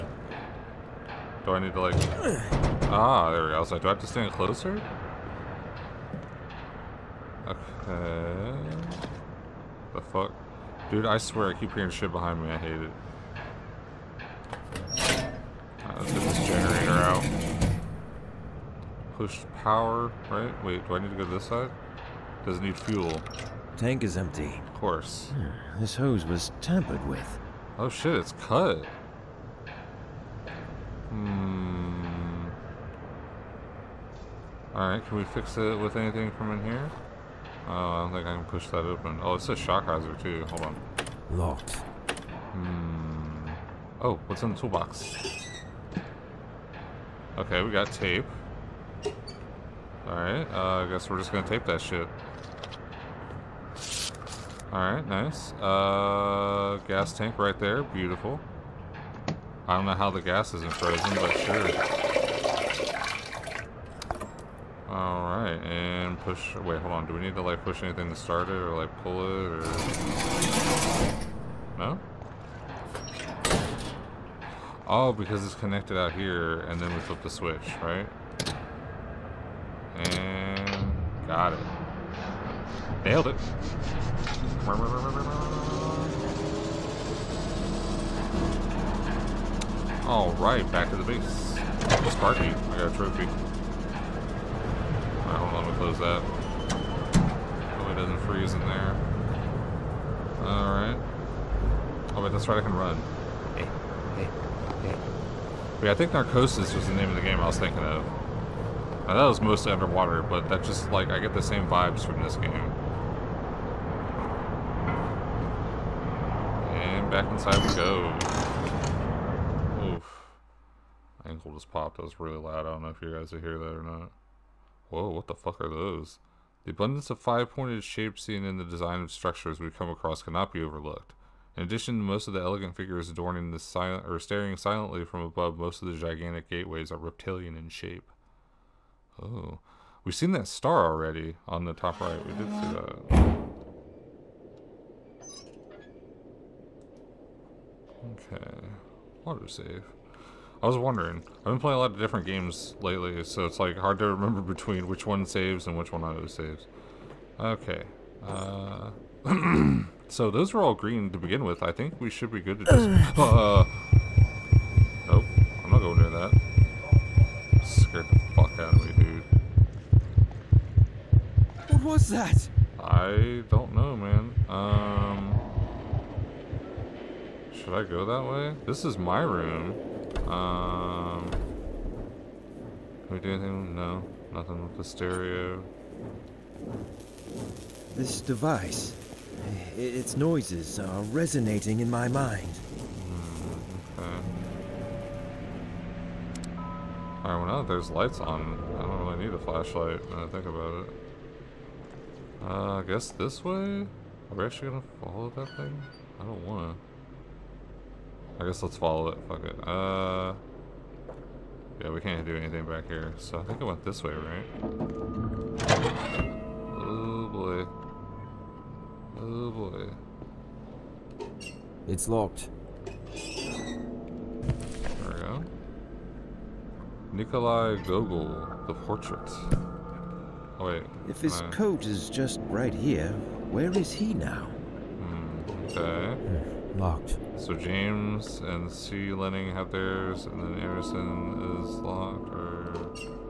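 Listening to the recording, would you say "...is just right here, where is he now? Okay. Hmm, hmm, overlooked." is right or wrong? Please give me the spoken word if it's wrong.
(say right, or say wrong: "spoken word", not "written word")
wrong: "locked", not "overlooked".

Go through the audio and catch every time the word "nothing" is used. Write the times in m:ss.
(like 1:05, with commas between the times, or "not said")
3:04.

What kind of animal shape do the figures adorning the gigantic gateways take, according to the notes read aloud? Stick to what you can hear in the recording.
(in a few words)
Reptilian.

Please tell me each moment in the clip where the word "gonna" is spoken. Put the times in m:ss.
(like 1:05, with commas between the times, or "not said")
0:51, 3:24.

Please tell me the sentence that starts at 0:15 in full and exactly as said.
let's get this generator out push power, right?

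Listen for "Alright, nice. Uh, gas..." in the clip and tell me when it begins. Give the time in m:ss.
0:54.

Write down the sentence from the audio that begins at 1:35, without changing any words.
Alright, hold on, let me close that.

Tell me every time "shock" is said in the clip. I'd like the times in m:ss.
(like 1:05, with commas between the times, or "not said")
0:39.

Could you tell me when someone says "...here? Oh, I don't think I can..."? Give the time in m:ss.
0:36.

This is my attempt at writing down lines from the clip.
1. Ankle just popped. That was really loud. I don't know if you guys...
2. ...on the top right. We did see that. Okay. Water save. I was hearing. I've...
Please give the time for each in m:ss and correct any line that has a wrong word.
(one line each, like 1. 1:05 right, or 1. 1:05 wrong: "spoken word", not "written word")
1. 2:01 right
2. 2:21 wrong: "wondering", not "hearing".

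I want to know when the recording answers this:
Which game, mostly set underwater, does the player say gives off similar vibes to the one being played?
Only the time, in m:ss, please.
1:46.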